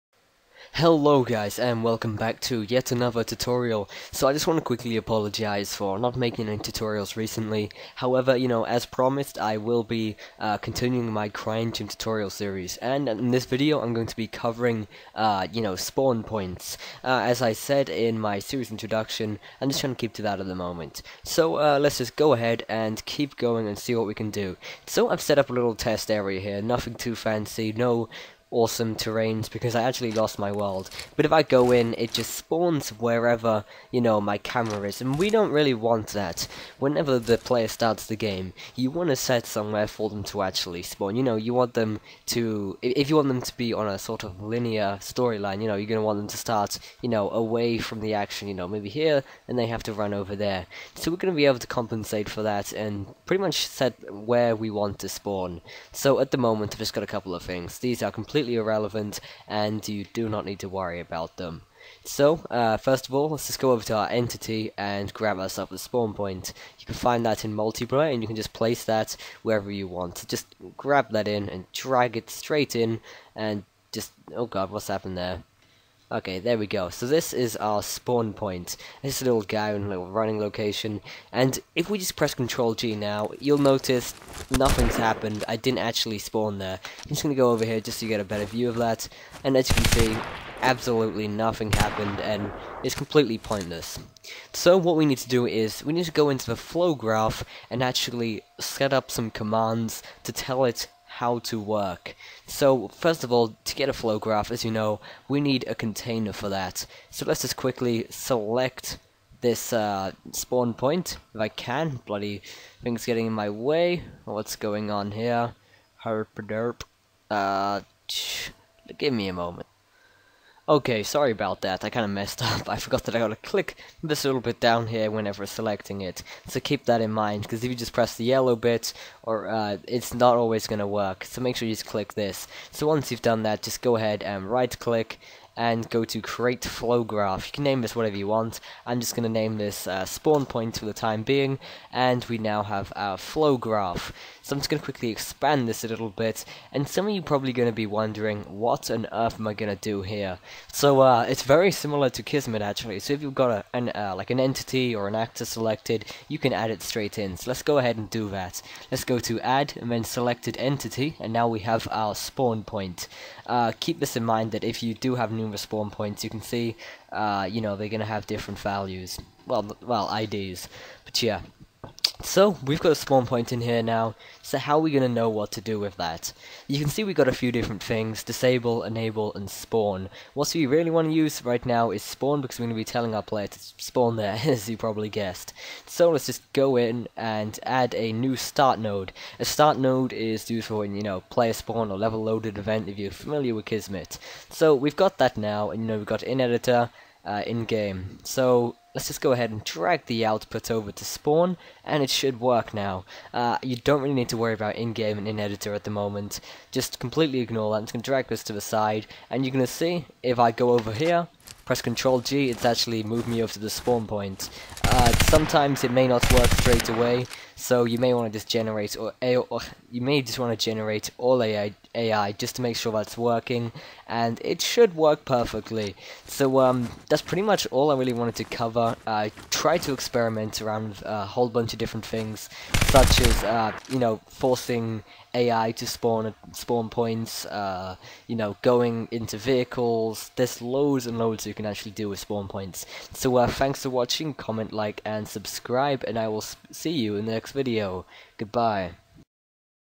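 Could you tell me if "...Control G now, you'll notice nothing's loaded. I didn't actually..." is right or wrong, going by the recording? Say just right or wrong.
wrong.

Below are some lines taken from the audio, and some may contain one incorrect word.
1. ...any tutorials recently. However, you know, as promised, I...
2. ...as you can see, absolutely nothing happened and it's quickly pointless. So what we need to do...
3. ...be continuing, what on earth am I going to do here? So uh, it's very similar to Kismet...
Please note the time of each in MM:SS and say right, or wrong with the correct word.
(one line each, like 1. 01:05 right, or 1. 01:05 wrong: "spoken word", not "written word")
1. 00:06 right
2. 01:29 wrong: "completely", not "quickly"
3. 02:27 wrong: "wondering", not "continuing".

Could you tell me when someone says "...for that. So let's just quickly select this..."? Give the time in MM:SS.
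01:46.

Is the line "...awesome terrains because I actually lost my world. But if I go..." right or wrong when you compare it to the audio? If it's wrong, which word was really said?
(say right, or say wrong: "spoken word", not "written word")
right.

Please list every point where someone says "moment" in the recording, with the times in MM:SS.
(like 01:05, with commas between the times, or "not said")
00:20, 00:56, 01:59, 03:25.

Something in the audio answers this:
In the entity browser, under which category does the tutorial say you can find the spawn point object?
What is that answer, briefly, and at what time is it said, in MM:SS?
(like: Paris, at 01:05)
Multiplayer, at 01:07.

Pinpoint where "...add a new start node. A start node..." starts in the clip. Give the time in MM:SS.
03:07.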